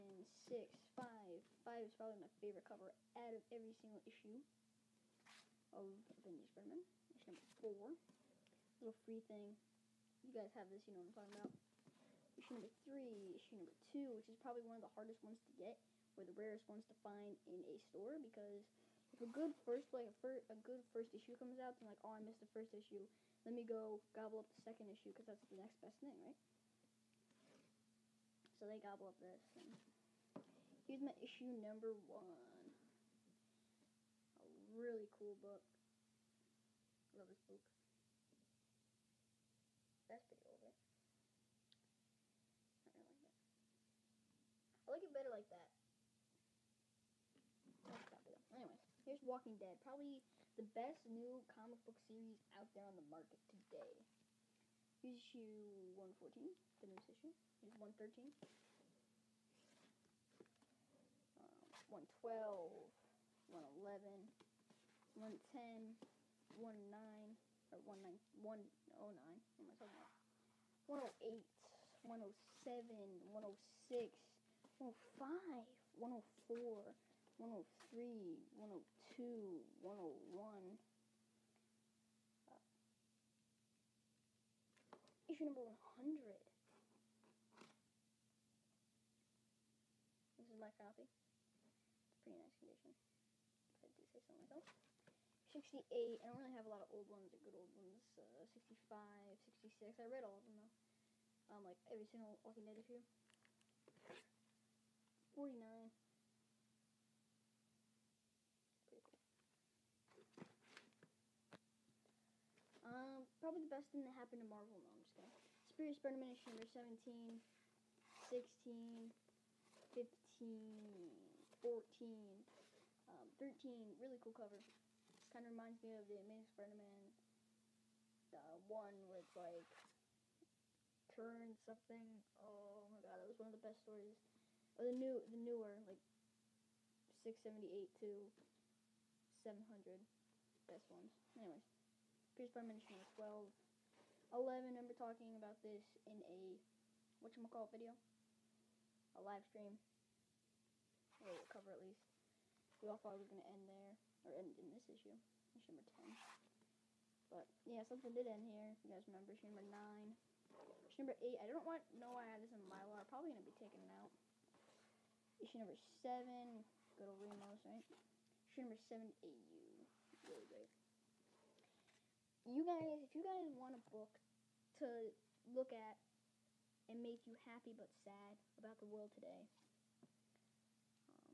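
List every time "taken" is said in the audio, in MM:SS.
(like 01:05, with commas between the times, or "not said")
02:43.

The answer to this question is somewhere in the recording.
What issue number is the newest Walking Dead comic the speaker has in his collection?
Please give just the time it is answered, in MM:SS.
00:55.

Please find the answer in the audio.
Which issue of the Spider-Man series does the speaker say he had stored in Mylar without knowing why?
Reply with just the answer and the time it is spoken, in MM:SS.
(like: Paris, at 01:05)
8, at 02:40.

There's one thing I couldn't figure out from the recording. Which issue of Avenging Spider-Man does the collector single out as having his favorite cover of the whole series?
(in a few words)
5.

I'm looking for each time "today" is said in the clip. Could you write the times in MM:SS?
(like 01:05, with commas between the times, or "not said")
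00:53, 02:59.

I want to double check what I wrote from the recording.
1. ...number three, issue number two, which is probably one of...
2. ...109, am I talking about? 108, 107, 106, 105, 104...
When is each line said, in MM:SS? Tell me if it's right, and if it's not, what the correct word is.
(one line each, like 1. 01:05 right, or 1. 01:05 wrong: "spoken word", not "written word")
1. 00:12 right
2. 01:08 right.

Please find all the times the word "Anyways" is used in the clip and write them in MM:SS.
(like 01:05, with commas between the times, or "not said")
00:48, 02:21.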